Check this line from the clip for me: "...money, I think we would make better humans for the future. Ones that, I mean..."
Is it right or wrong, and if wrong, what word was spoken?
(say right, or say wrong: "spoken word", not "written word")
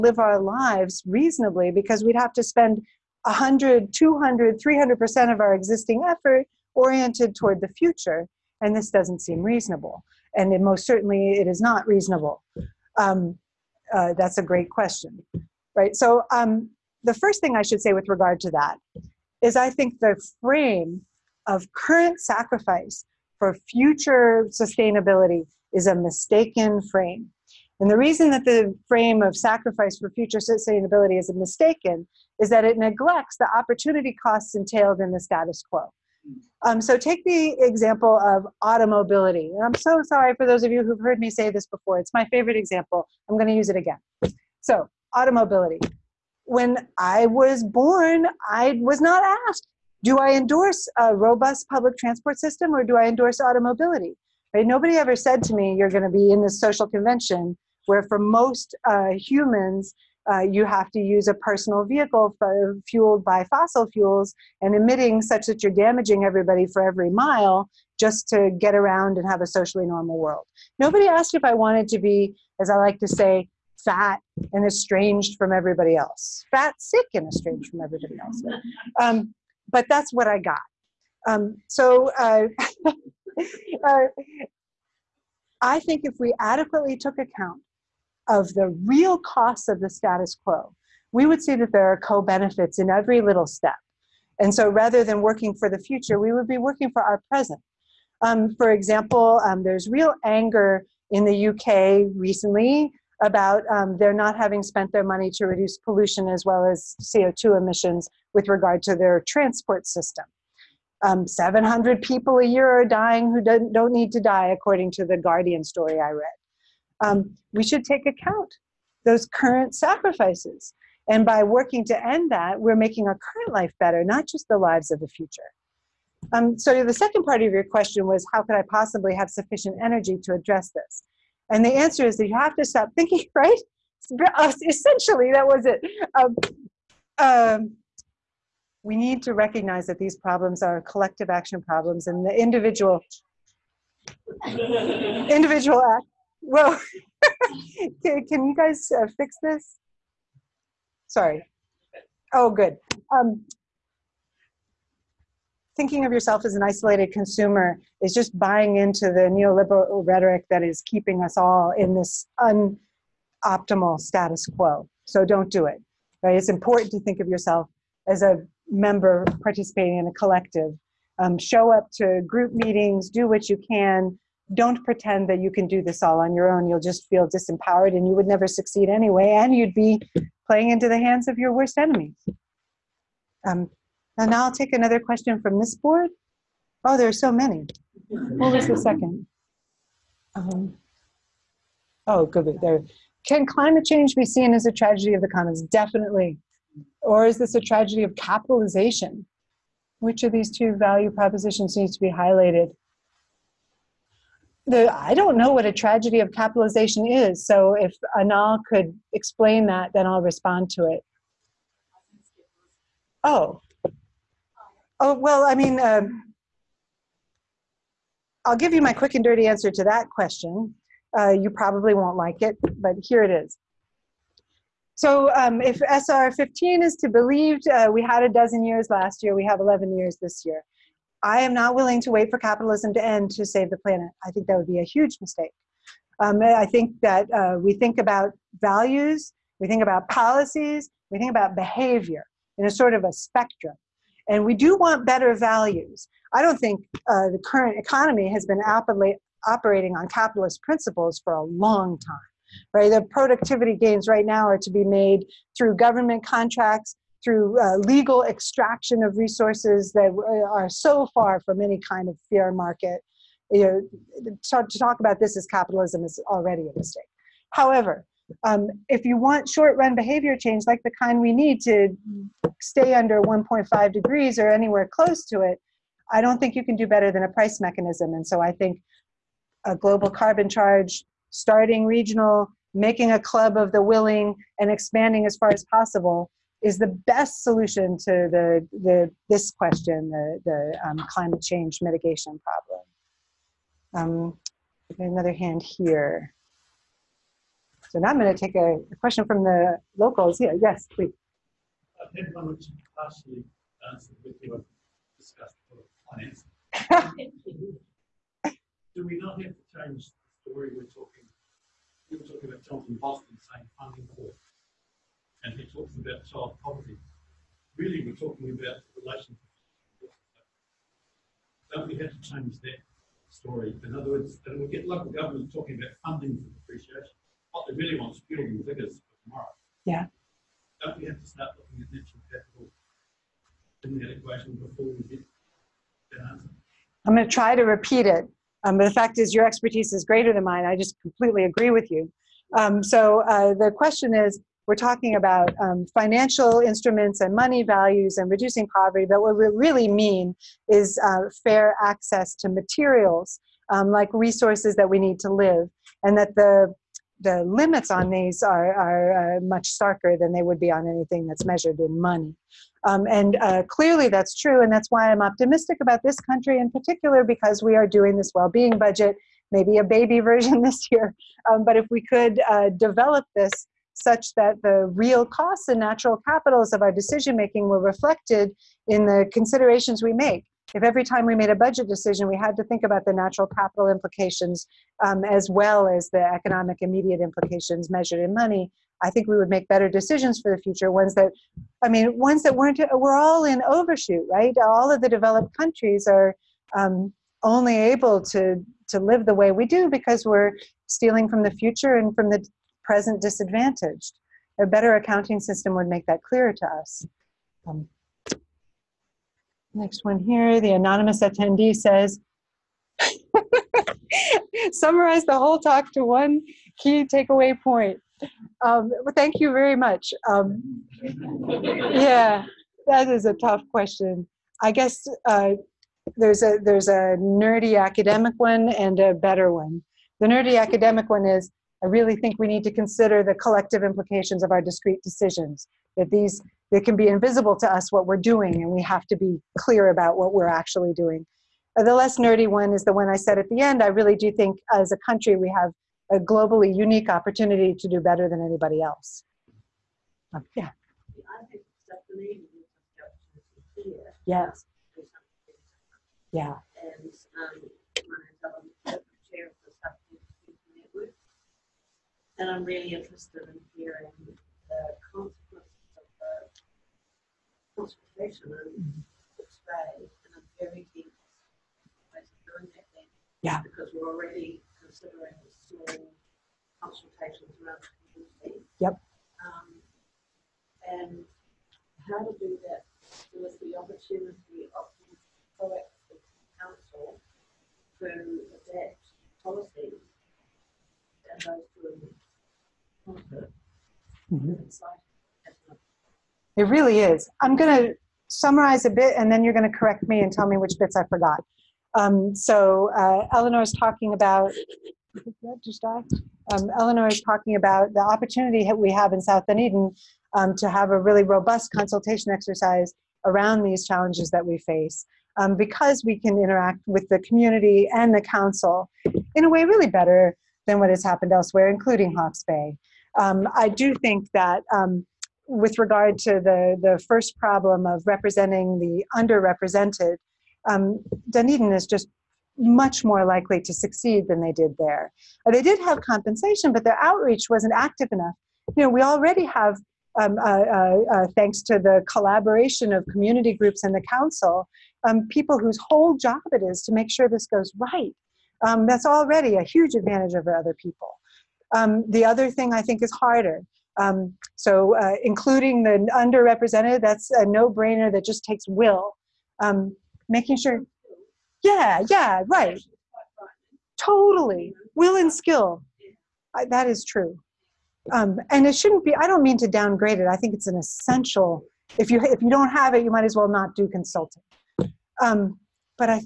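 wrong: "decisions", not "humans".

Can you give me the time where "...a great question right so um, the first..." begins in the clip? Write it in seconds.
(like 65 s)
14 s.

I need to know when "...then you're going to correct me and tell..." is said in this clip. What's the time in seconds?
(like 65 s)
499 s.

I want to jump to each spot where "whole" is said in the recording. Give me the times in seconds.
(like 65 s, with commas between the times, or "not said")
415 s, 545 s.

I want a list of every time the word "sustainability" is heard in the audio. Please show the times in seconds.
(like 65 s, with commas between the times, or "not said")
24 s, 30 s.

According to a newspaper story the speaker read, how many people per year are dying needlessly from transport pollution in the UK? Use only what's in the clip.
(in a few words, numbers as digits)
700.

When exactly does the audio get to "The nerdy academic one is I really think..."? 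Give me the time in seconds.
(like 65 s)
430 s.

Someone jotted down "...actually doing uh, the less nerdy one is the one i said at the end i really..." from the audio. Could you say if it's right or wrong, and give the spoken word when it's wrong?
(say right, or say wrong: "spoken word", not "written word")
right.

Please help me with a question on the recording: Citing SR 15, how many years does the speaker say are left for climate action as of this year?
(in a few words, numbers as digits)
11.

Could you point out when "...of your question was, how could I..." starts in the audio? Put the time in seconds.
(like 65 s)
127 s.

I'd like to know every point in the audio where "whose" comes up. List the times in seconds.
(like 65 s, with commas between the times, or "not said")
545 s.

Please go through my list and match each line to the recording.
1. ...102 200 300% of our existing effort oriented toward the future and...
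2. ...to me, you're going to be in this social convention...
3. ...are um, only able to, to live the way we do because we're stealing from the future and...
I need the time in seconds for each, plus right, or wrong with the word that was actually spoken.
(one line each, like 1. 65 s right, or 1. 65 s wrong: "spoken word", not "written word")
1. 3 s wrong: "100", not "102"
2. 55 s right
3. 396 s right.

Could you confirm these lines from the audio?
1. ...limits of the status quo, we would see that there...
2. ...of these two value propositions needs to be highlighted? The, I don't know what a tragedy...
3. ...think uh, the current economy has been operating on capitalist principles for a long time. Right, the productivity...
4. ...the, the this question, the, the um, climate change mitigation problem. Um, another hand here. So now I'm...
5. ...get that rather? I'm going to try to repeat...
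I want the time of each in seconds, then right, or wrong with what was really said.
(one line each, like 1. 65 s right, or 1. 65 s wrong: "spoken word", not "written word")
1. 89 s wrong: "costs", not "limits"
2. 200 s right
3. 246 s right
4. 288 s right
5. 335 s wrong: "answer", not "rather".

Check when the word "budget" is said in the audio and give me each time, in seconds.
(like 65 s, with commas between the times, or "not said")
368 s, 381 s.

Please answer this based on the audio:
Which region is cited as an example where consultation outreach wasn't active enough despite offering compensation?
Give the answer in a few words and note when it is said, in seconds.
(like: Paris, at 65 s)
Hawke's Bay, at 522 s.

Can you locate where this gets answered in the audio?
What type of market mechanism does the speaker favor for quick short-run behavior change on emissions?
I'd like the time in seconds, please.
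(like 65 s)
277 s.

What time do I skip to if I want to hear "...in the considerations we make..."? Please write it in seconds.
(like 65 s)
378 s.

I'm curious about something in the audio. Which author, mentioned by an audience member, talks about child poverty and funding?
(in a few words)
Jonathan Boston.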